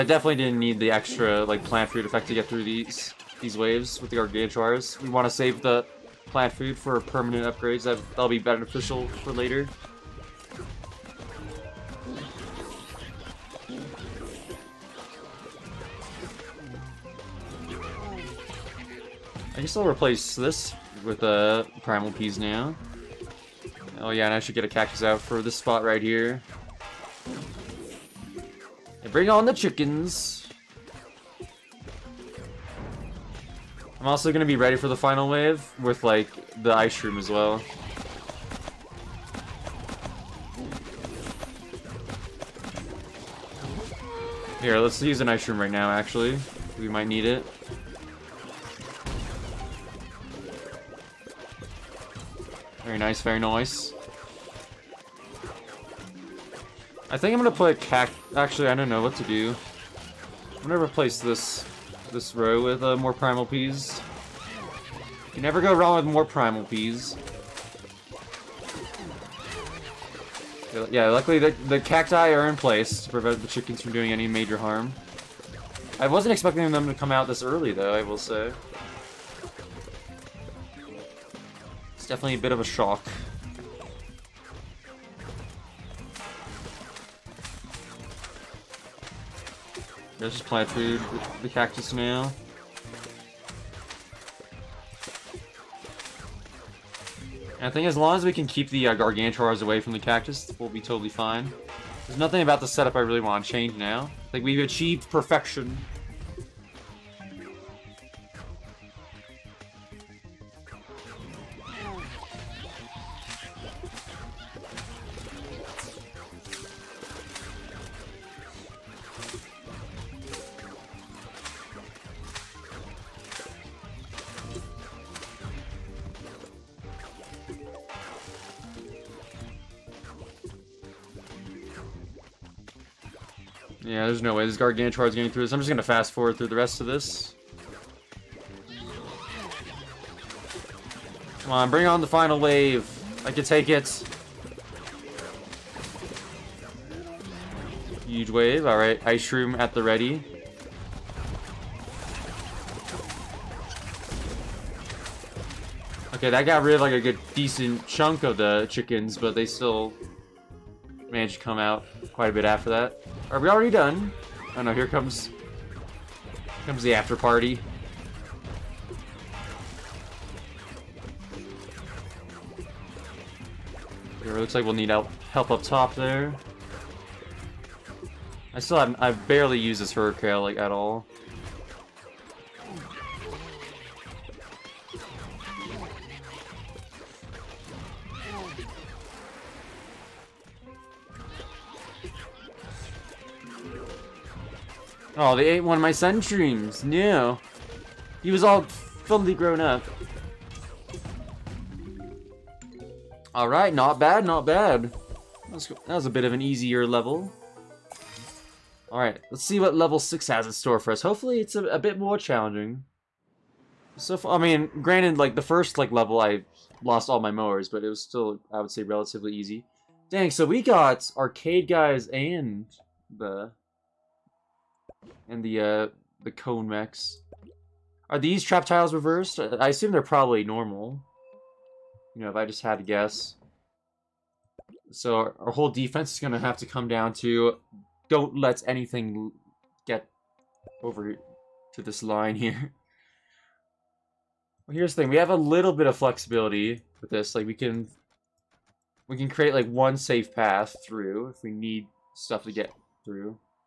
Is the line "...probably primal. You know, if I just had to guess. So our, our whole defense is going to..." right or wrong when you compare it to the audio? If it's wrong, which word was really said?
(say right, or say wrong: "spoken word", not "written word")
wrong: "normal", not "primal".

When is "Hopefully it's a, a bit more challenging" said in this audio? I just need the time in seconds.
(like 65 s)
211 s.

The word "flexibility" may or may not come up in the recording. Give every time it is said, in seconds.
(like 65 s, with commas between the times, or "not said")
245 s.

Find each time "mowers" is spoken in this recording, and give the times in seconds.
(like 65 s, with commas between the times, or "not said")
217 s.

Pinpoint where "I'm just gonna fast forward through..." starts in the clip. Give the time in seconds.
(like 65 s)
135 s.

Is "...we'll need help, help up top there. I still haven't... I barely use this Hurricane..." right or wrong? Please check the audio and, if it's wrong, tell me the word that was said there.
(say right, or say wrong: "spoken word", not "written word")
right.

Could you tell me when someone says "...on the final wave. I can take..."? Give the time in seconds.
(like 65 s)
141 s.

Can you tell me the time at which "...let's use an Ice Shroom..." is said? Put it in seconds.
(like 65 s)
44 s.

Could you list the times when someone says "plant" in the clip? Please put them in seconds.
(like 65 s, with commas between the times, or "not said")
1 s, 6 s, 90 s.